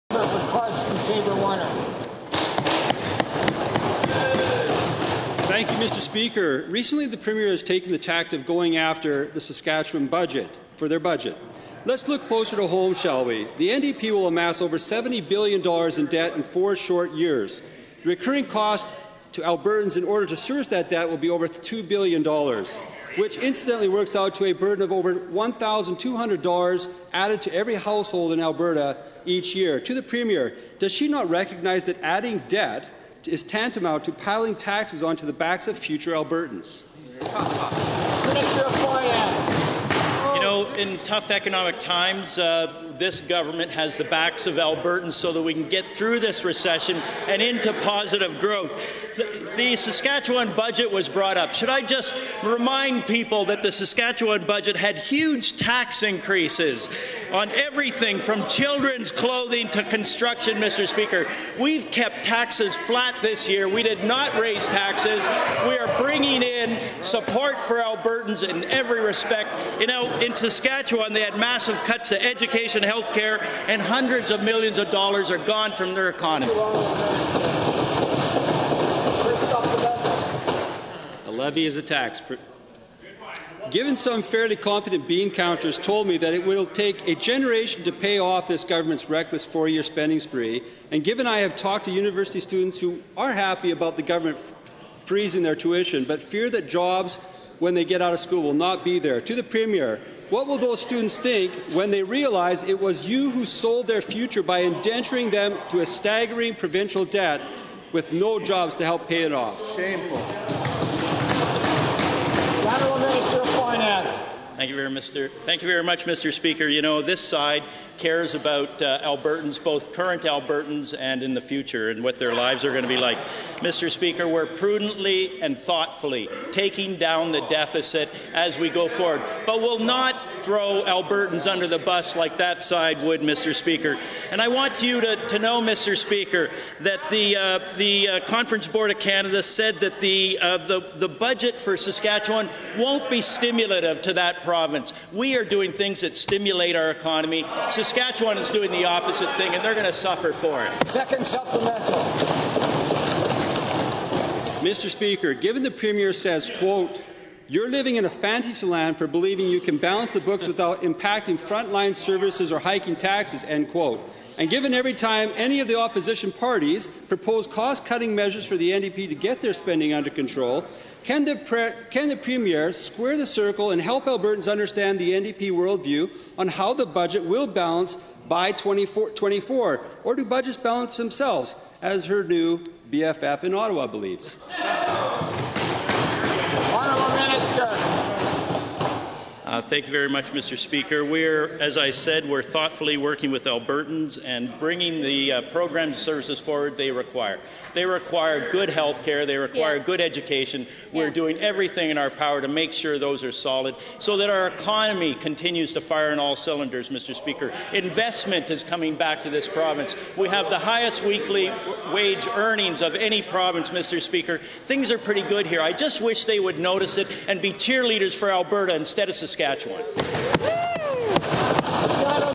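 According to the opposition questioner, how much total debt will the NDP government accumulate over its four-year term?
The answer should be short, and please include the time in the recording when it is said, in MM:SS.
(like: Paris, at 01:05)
over $70 billion, at 00:14.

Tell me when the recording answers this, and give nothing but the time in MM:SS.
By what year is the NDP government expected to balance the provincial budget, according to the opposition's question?
02:58.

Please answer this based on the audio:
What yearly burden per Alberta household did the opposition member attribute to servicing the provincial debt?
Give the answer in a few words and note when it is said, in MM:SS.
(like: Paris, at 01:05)
over $1,200, at 00:24.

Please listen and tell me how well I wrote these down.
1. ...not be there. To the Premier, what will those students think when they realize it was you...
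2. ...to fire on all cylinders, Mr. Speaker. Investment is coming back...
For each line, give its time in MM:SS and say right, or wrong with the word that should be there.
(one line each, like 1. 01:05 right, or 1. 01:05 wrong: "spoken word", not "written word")
1. 01:38 right
2. 03:25 right.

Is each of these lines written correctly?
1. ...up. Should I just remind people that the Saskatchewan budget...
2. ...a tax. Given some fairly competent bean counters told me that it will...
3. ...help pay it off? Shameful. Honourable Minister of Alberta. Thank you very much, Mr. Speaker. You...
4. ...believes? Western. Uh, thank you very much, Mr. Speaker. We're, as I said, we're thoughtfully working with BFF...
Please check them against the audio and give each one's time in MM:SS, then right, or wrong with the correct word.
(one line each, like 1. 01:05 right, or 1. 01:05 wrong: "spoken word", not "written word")
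1. 00:51 right
2. 01:21 right
3. 01:48 wrong: "Finance", not "Alberta"
4. 03:03 wrong: "Albertans", not "BFF".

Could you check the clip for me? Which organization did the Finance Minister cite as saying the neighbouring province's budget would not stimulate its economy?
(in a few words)
Conference Board of Canada.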